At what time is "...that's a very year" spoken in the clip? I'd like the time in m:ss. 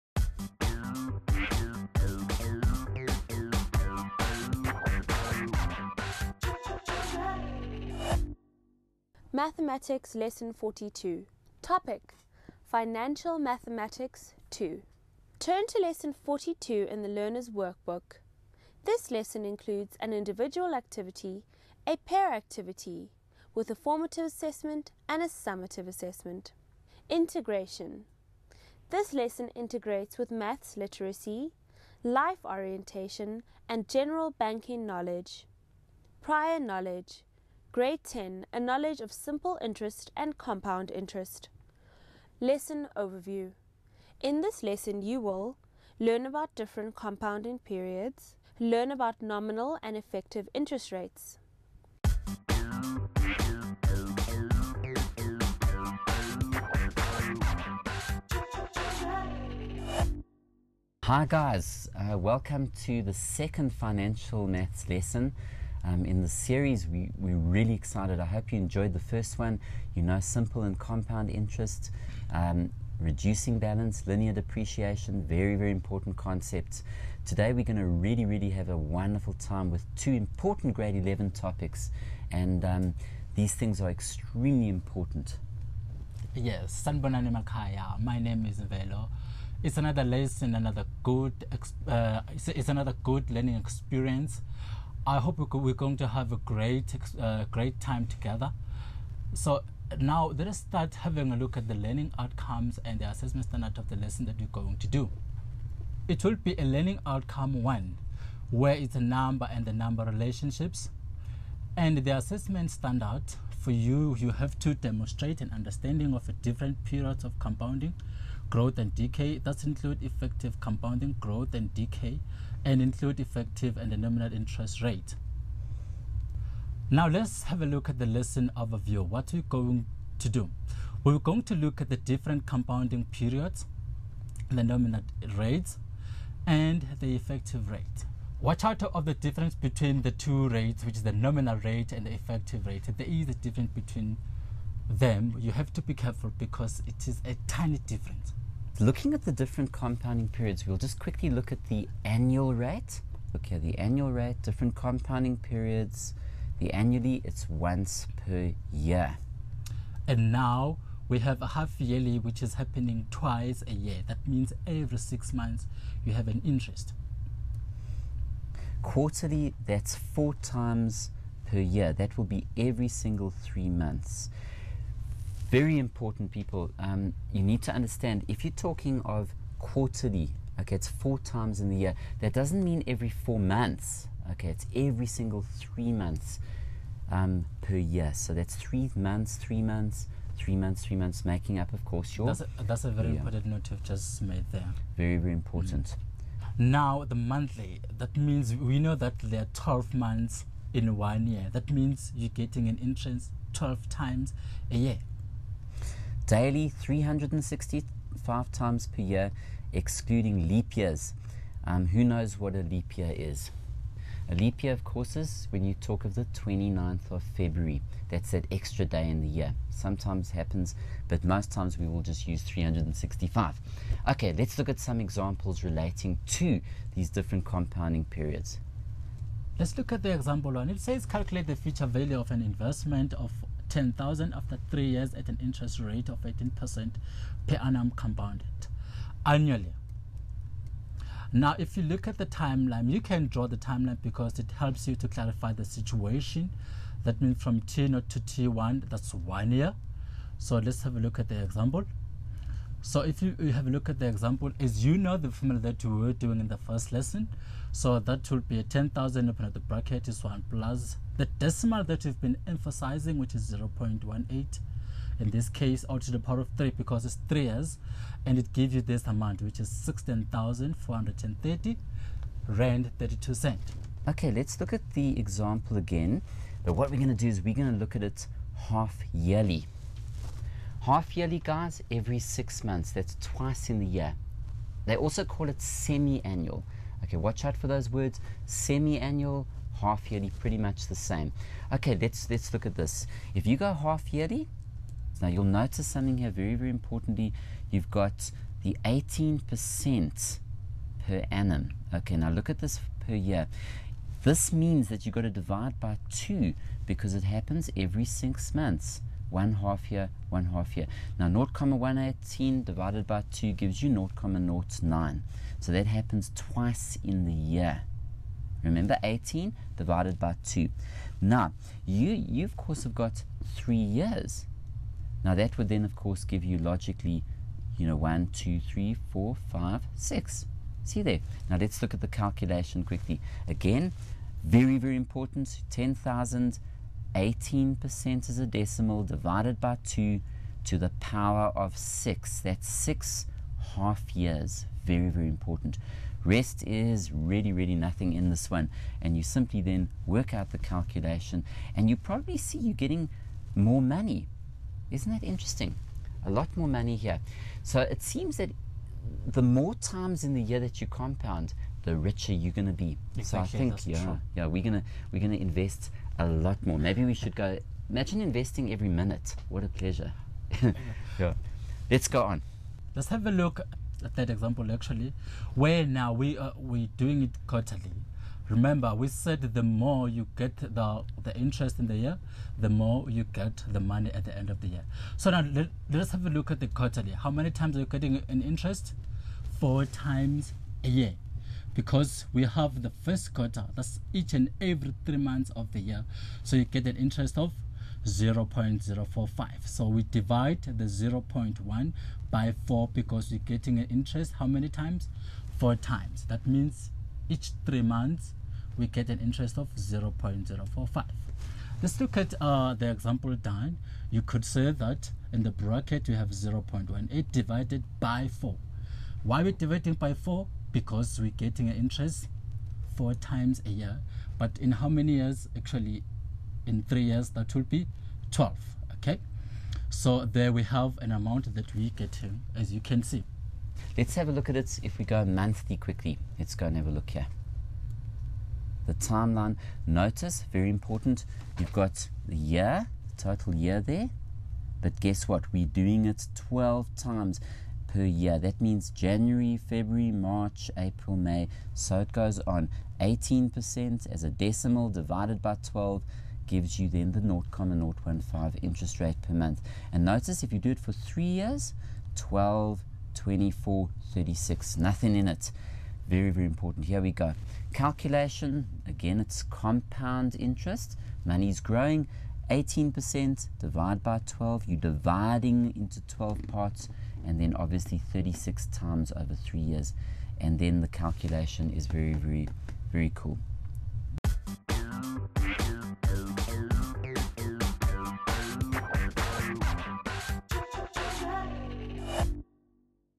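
3:12.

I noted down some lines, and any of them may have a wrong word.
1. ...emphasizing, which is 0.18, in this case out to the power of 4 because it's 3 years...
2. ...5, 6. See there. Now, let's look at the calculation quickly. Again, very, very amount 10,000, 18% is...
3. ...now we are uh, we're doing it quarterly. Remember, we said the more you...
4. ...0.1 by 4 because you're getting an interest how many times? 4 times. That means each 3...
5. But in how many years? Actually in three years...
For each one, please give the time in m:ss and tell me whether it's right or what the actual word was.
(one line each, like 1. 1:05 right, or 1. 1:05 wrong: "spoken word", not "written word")
1. 4:22 wrong: "3", not "4"
2. 5:29 wrong: "important", not "amount"
3. 6:15 right
4. 6:40 right
5. 7:04 right.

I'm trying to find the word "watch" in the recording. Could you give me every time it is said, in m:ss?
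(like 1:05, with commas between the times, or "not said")
2:18, 4:47.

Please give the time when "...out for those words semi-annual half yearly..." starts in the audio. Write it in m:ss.
4:47.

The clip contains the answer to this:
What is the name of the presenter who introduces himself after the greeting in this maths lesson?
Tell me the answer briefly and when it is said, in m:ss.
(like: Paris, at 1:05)
Velo, at 1:28.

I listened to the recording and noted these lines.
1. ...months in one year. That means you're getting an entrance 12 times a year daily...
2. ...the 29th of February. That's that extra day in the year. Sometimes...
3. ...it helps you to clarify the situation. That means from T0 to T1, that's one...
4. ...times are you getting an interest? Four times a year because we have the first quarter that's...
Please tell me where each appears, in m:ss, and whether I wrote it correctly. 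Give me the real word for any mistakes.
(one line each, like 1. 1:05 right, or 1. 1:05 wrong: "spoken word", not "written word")
1. 3:19 right
2. 3:36 right
3. 4:04 right
4. 6:27 right.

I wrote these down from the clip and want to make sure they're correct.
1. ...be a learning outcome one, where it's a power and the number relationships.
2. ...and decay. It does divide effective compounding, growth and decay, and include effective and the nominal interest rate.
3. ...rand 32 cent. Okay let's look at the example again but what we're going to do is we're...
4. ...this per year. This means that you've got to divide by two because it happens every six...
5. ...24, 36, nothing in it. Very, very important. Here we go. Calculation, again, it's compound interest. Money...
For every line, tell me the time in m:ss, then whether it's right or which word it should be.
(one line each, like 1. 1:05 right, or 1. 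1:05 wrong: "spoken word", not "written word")
1. 1:46 wrong: "number", not "power"
2. 1:58 wrong: "include", not "divide"
3. 4:32 right
4. 5:02 right
5. 7:43 right.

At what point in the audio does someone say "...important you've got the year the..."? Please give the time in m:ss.
7:20.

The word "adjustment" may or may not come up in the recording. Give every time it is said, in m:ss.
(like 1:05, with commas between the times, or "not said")
not said.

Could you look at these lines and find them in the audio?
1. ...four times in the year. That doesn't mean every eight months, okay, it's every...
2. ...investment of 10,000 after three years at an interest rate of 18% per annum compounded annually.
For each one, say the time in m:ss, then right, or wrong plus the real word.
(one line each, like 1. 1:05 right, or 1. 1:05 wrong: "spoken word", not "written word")
1. 3:00 wrong: "four", not "eight"
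2. 3:52 right.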